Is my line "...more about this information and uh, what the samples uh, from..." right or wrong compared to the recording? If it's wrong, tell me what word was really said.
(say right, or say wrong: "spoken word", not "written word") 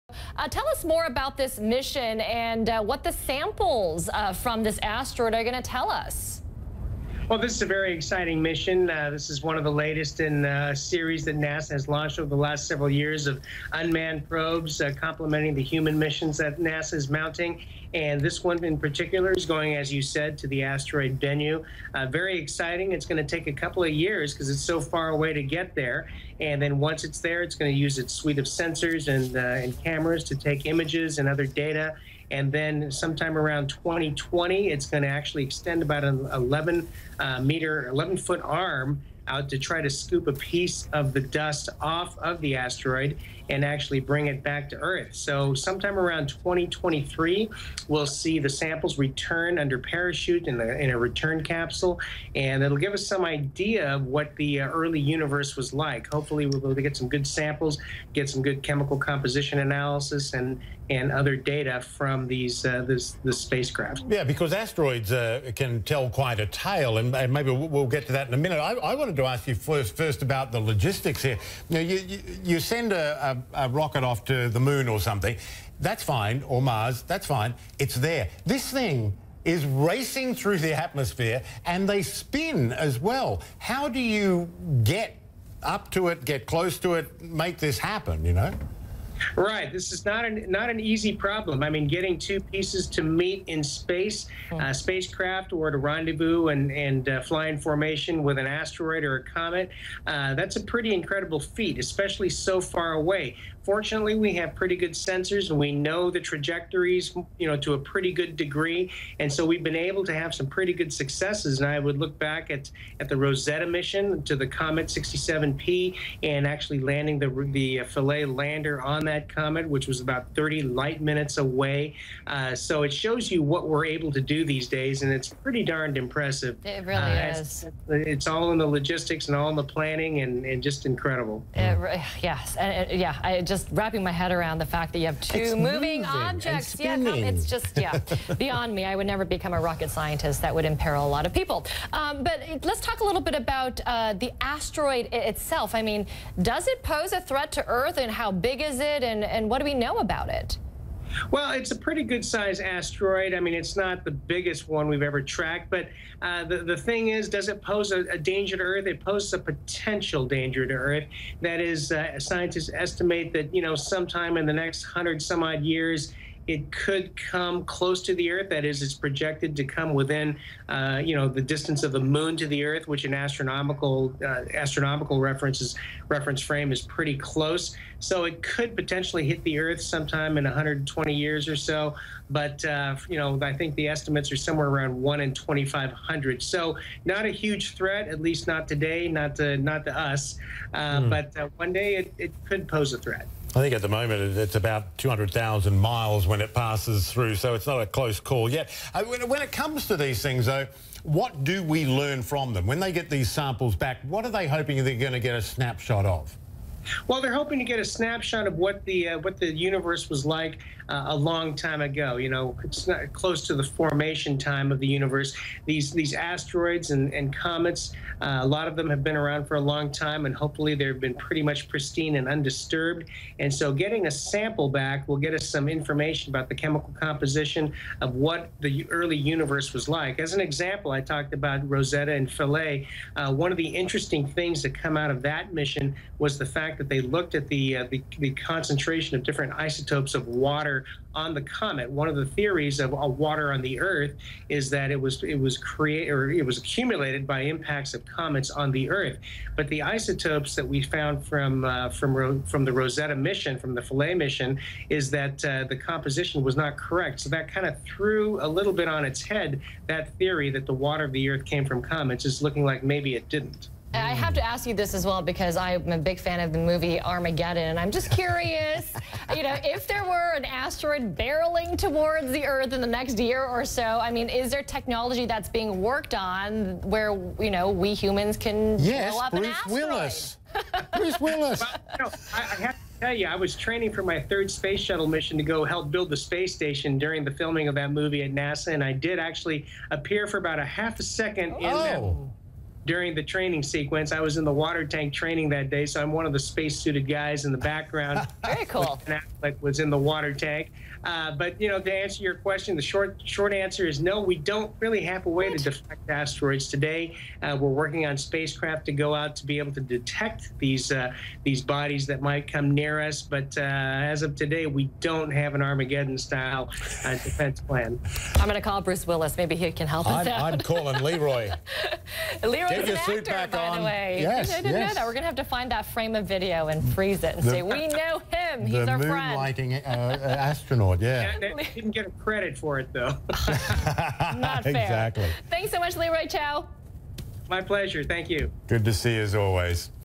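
wrong: "mission", not "information".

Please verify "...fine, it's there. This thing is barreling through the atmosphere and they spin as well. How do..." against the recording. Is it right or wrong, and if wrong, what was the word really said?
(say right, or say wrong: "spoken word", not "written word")
wrong: "racing", not "barreling".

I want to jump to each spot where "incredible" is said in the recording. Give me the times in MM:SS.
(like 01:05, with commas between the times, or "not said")
01:40, 02:10.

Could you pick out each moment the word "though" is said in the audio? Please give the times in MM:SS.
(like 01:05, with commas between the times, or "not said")
03:20, 05:32.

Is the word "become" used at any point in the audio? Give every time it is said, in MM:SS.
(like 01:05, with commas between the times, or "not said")
02:19.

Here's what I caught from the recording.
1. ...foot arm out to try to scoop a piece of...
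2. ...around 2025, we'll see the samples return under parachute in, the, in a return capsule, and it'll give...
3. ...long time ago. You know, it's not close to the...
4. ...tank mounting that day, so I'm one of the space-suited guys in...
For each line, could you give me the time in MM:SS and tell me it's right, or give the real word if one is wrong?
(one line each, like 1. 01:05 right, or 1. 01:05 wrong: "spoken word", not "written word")
1. 00:38 right
2. 00:45 wrong: "2023", not "2025"
3. 03:31 right
4. 04:54 wrong: "training", not "mounting".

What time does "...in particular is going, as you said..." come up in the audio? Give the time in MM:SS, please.
00:18.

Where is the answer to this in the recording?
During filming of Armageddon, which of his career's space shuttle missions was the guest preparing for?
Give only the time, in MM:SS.
04:44.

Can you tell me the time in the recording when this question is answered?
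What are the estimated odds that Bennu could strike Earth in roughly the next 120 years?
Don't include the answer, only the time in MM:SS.
03:04.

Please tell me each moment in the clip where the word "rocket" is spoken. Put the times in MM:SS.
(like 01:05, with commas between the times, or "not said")
01:13, 02:19.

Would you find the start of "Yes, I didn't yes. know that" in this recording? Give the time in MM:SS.
05:24.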